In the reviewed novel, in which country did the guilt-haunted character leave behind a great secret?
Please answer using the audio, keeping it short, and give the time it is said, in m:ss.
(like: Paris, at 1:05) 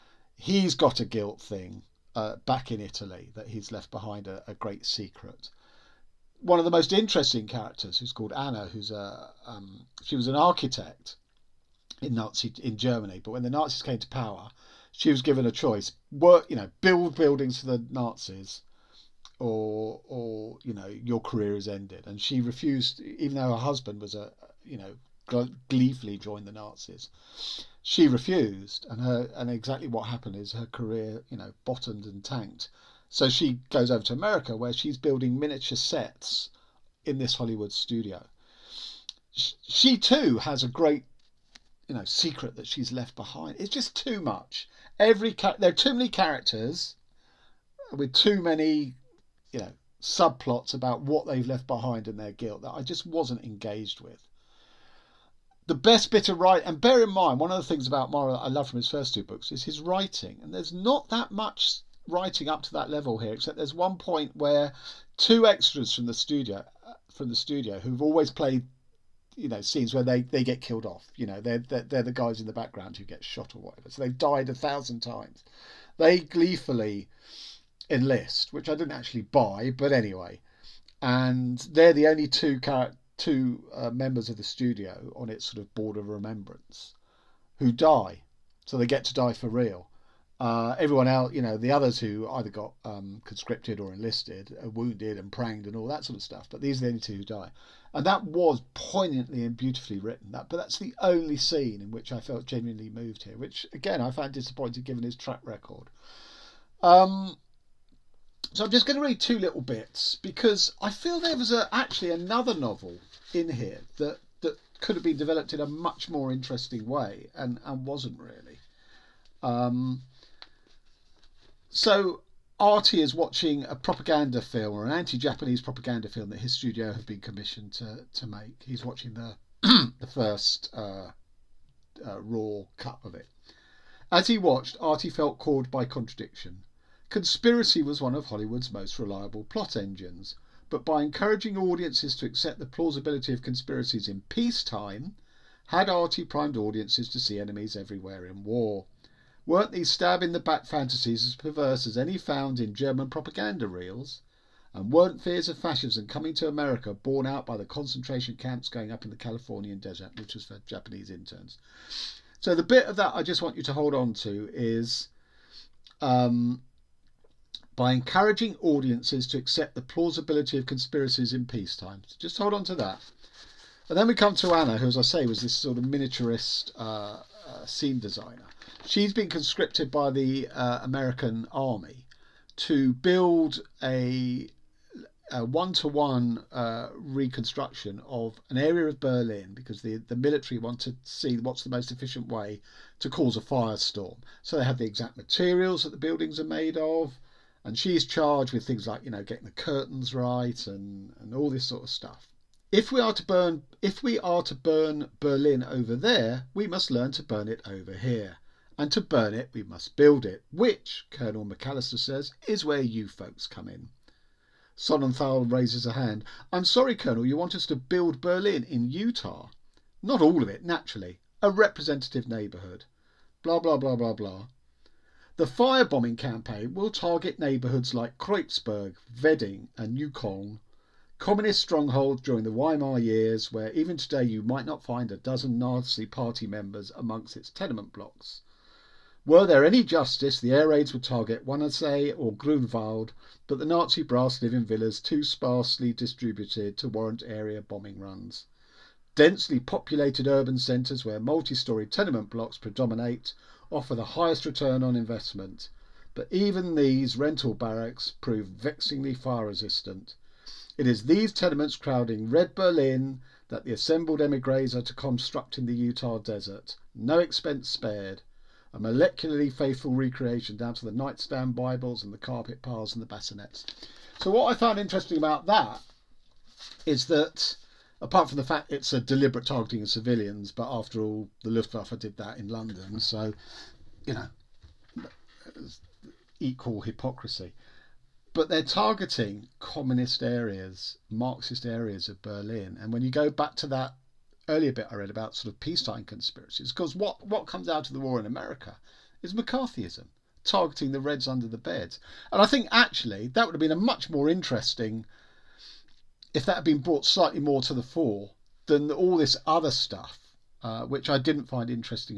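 Italy, at 0:02.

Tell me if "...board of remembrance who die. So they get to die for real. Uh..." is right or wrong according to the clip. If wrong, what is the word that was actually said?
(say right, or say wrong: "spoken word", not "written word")
right.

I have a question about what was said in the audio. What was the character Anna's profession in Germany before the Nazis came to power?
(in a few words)
Architect.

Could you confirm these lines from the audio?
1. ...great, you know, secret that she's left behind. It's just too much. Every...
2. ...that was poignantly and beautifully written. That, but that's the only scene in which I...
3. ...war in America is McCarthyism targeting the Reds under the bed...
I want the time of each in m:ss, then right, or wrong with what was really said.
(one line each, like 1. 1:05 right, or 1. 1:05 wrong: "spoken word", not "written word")
1. 0:40 right
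2. 1:38 right
3. 4:57 right.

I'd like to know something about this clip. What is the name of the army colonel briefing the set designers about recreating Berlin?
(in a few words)
Colonel McAllister.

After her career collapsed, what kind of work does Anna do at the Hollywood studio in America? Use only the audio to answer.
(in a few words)
Building miniature sets.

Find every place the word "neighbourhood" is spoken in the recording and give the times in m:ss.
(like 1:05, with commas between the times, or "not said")
3:42, 3:47.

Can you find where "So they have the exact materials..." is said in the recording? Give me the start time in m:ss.
3:14.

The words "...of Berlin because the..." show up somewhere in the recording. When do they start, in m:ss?
3:08.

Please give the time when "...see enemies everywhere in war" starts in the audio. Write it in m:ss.
2:27.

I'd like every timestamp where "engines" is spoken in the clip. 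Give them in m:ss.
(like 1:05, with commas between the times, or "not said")
2:19.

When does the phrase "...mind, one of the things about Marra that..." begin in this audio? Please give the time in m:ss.
0:57.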